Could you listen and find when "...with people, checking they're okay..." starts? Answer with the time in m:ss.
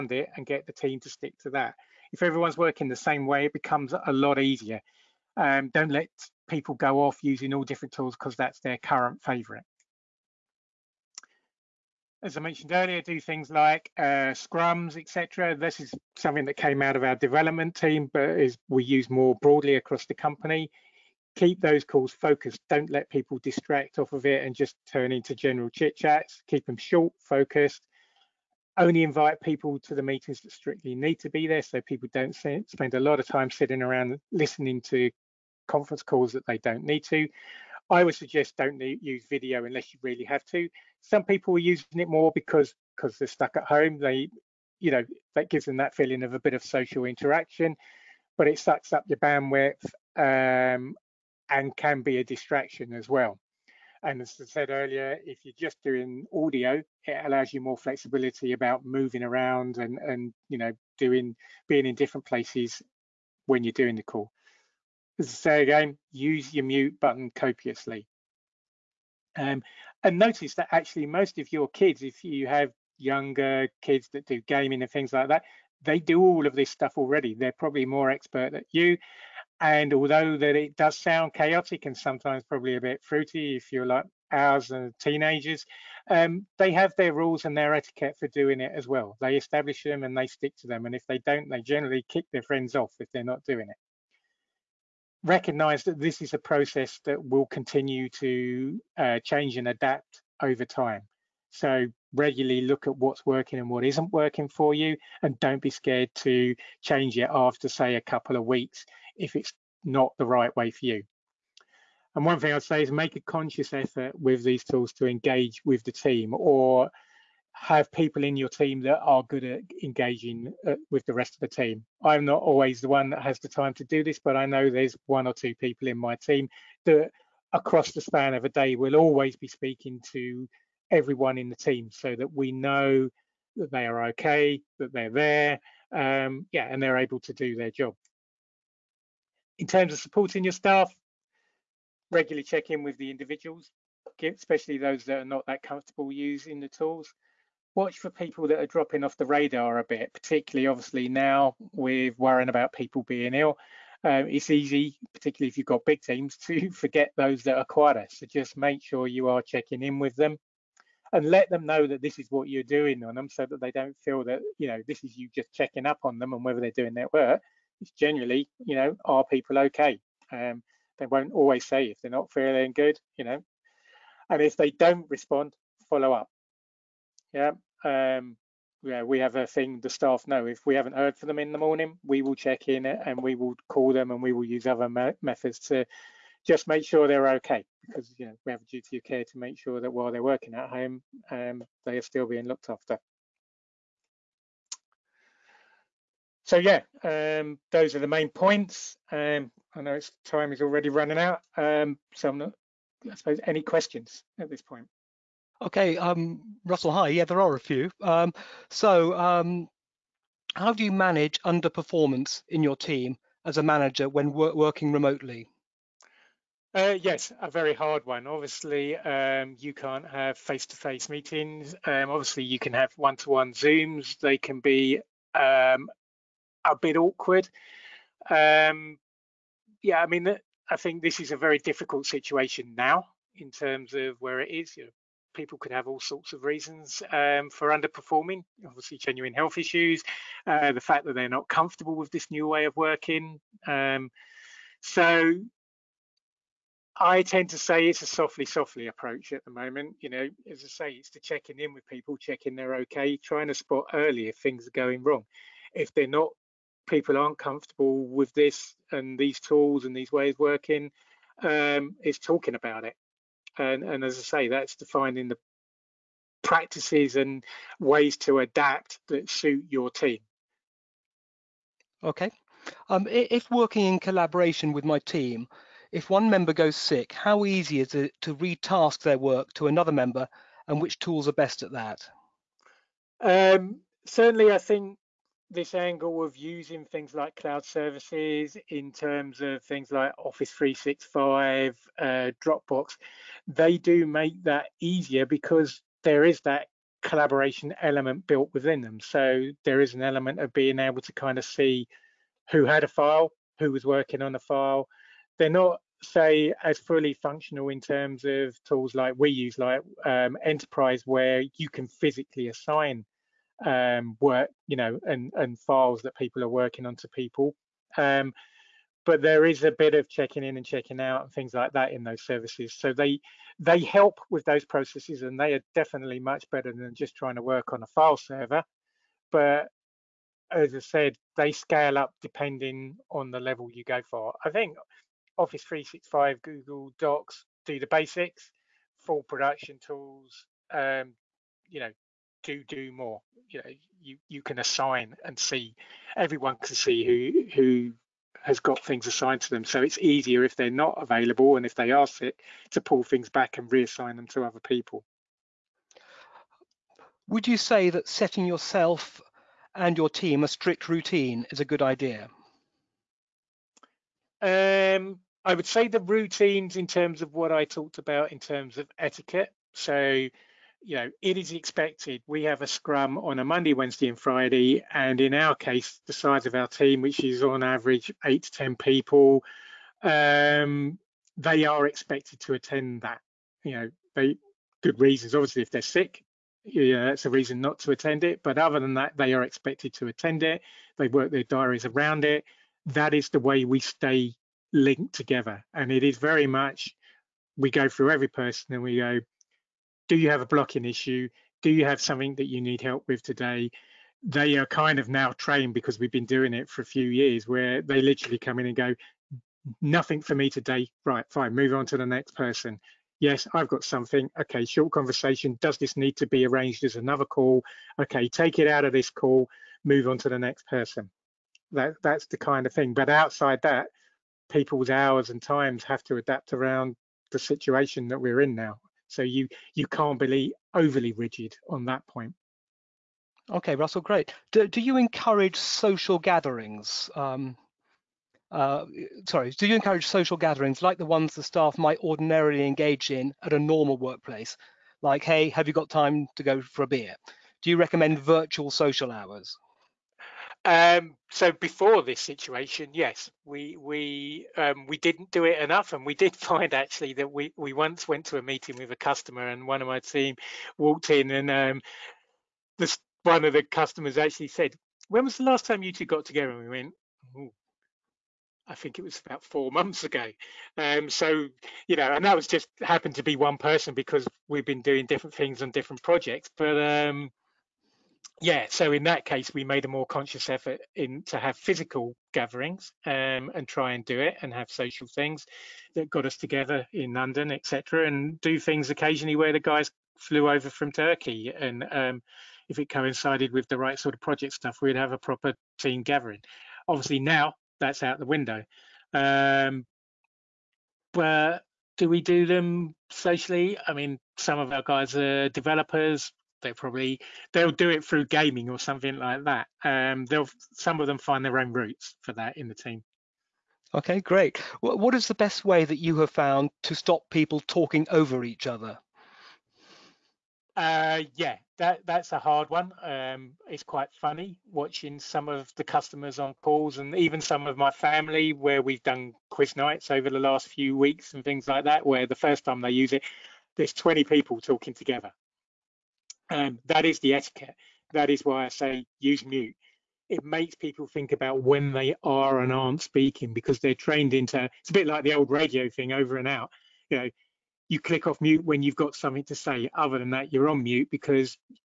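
4:11.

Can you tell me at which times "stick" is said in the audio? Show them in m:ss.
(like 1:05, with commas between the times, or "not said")
0:01, 1:30.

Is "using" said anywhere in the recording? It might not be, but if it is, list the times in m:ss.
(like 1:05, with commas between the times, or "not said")
0:07, 0:41, 2:26, 4:46.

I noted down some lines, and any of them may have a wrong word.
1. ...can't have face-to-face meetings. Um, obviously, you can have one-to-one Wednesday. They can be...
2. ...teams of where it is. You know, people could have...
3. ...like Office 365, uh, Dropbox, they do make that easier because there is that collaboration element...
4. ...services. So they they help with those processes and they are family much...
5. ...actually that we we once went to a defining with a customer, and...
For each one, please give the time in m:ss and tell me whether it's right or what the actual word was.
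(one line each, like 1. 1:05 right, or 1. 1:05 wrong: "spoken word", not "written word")
1. 3:39 wrong: "Zooms", not "Wednesday"
2. 3:53 wrong: "terms", not "teams"
3. 4:49 right
4. 5:22 wrong: "definitely", not "family"
5. 7:36 wrong: "meeting", not "defining".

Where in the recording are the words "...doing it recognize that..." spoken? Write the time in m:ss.
1:33.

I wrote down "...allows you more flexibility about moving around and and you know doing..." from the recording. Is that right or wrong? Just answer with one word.
right.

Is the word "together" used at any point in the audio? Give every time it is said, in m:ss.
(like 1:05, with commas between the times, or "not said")
6:35, 7:46, 8:06, 8:54.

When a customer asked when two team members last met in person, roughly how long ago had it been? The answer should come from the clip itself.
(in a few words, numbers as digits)
About 4 months.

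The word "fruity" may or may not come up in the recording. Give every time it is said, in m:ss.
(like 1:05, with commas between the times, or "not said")
1:23.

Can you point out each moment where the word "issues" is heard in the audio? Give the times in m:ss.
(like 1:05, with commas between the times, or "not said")
3:59, 6:40.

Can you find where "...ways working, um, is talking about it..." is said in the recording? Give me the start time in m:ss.
4:20.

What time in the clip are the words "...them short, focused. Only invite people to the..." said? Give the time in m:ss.
0:26.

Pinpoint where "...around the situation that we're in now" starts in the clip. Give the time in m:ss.
7:06.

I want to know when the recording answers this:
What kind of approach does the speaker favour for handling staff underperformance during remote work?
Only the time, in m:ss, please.
4:08.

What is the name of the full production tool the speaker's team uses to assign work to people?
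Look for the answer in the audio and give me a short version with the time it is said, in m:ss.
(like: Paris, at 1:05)
Enterprise, at 5:10.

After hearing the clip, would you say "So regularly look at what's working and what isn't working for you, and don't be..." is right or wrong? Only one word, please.
right.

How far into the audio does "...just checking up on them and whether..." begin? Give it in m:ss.
2:45.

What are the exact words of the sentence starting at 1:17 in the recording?
They're probably more expert at you.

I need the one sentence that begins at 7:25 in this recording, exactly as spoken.
Like, hey, have you got time to go for a beer?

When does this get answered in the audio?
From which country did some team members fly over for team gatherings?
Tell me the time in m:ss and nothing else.
8:10.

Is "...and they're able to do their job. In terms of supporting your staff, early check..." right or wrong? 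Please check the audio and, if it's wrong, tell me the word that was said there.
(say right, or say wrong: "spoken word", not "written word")
wrong: "regularly", not "early".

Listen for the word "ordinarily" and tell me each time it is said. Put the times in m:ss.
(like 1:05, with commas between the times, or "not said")
7:21.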